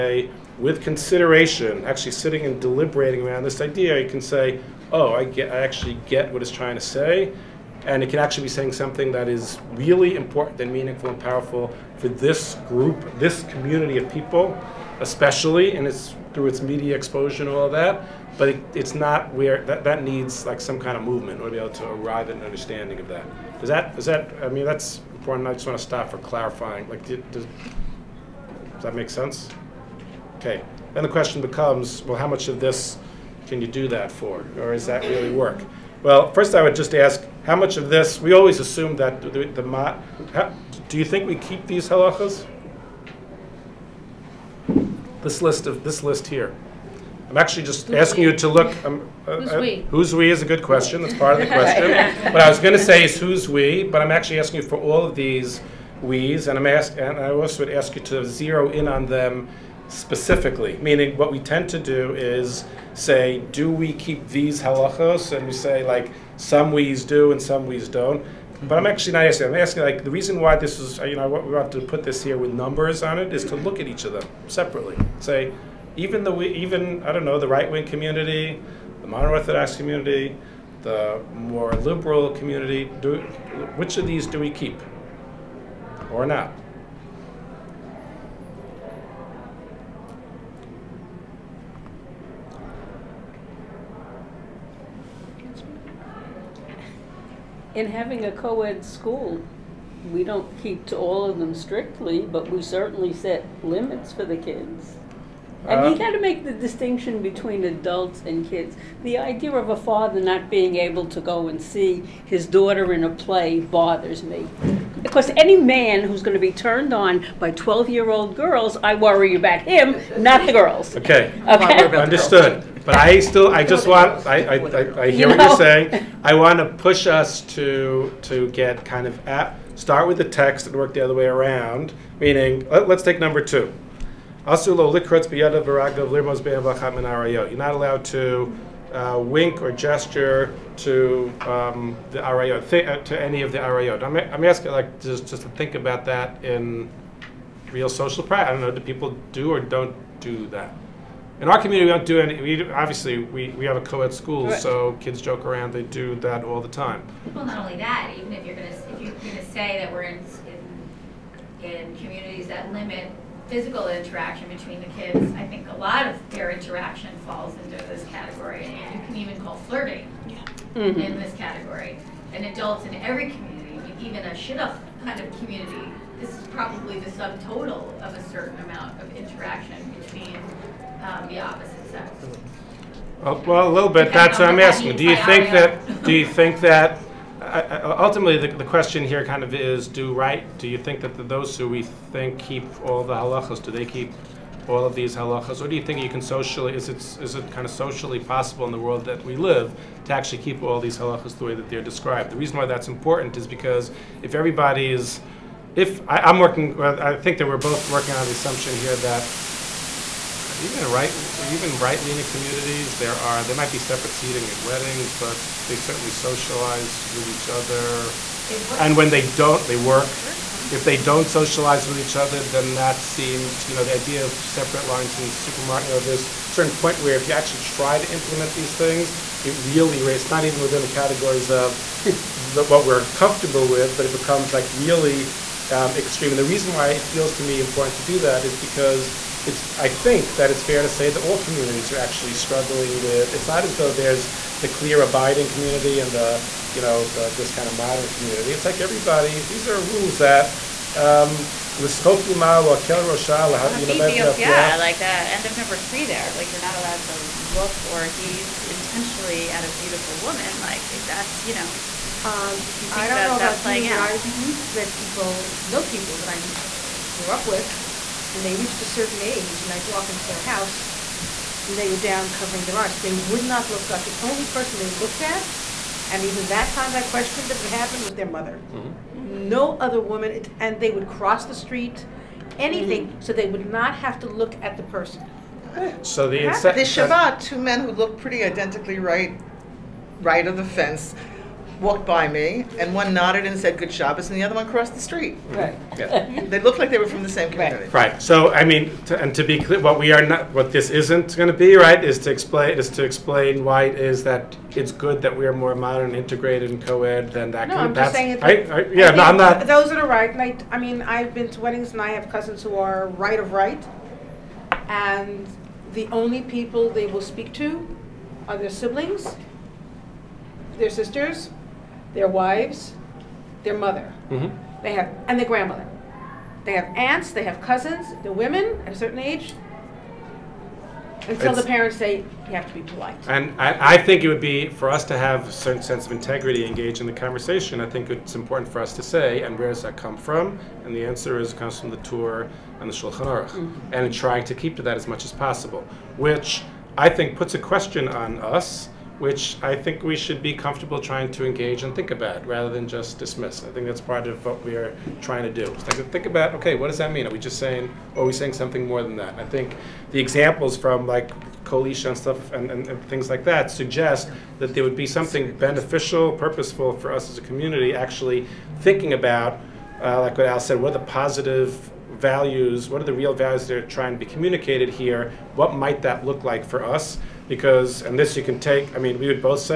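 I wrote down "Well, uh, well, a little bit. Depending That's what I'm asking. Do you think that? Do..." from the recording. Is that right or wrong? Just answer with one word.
right.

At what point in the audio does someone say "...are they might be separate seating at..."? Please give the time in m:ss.
3:33.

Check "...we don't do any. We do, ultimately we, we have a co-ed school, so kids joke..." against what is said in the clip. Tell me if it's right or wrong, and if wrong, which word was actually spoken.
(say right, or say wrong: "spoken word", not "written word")
wrong: "obviously", not "ultimately".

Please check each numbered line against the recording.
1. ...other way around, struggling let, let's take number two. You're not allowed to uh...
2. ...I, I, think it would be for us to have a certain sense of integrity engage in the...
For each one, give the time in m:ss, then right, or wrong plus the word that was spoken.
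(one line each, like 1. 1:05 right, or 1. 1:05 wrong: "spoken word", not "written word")
1. 2:10 wrong: "meaning", not "struggling"
2. 5:33 right.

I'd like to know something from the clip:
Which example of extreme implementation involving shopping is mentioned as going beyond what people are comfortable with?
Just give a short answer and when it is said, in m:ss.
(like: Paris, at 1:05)
separate lines in supermarket, at 3:44.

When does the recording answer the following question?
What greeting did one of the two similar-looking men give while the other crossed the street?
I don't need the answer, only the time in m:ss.
4:53.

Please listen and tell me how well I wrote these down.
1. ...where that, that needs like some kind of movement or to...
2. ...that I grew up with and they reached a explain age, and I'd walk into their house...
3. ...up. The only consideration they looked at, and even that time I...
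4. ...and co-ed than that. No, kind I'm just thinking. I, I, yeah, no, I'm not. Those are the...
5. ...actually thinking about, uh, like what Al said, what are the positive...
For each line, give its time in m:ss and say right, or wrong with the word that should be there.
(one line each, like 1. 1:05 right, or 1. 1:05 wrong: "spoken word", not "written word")
1. 0:19 right
2. 4:26 wrong: "certain", not "explain"
3. 4:33 wrong: "person", not "consideration"
4. 5:06 wrong: "saying", not "thinking"
5. 6:07 right.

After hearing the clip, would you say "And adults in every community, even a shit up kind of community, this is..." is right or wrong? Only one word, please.
right.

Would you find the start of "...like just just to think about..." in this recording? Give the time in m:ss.
2:24.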